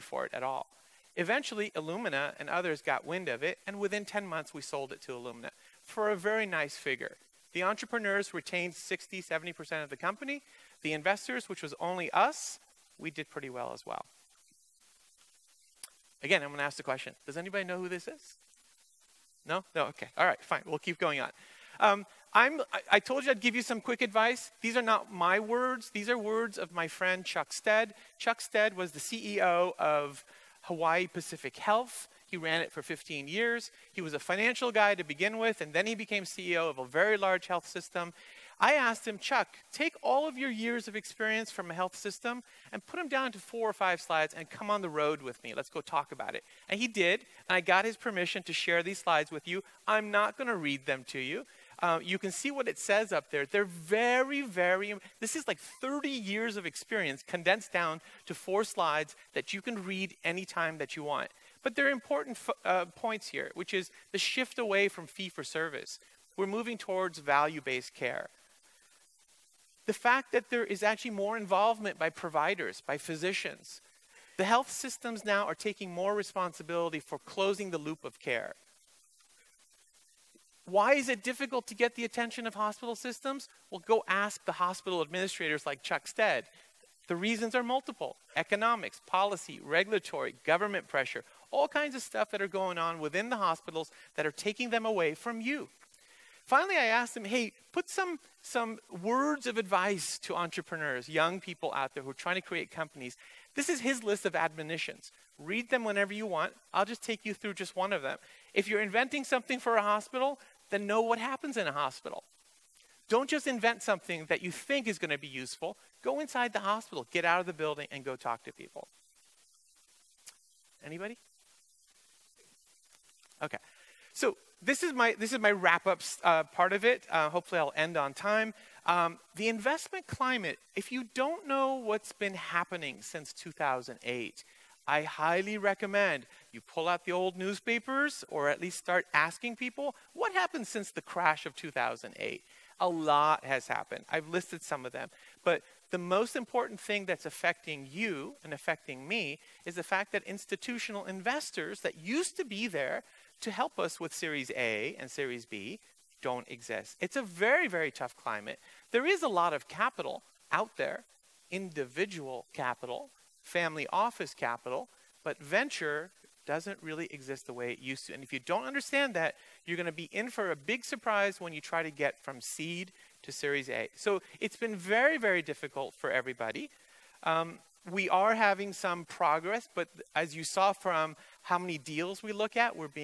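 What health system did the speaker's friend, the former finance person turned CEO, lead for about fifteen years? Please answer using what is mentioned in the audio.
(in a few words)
Hawaii Pacific Health.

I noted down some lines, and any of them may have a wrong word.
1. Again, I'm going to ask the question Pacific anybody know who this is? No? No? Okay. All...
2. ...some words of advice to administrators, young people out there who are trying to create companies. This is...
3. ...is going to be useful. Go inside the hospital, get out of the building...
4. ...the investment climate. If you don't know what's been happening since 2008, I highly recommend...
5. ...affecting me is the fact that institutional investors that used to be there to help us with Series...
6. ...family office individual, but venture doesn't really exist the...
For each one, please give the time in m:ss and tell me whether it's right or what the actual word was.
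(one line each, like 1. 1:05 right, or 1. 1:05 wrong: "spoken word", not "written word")
1. 0:16 wrong: "Does", not "Pacific"
2. 1:38 wrong: "entrepreneurs", not "administrators"
3. 1:54 right
4. 2:09 right
5. 2:28 right
6. 2:43 wrong: "capital", not "individual".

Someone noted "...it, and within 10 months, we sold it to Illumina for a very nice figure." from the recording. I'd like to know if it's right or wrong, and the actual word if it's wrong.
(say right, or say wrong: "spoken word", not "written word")
right.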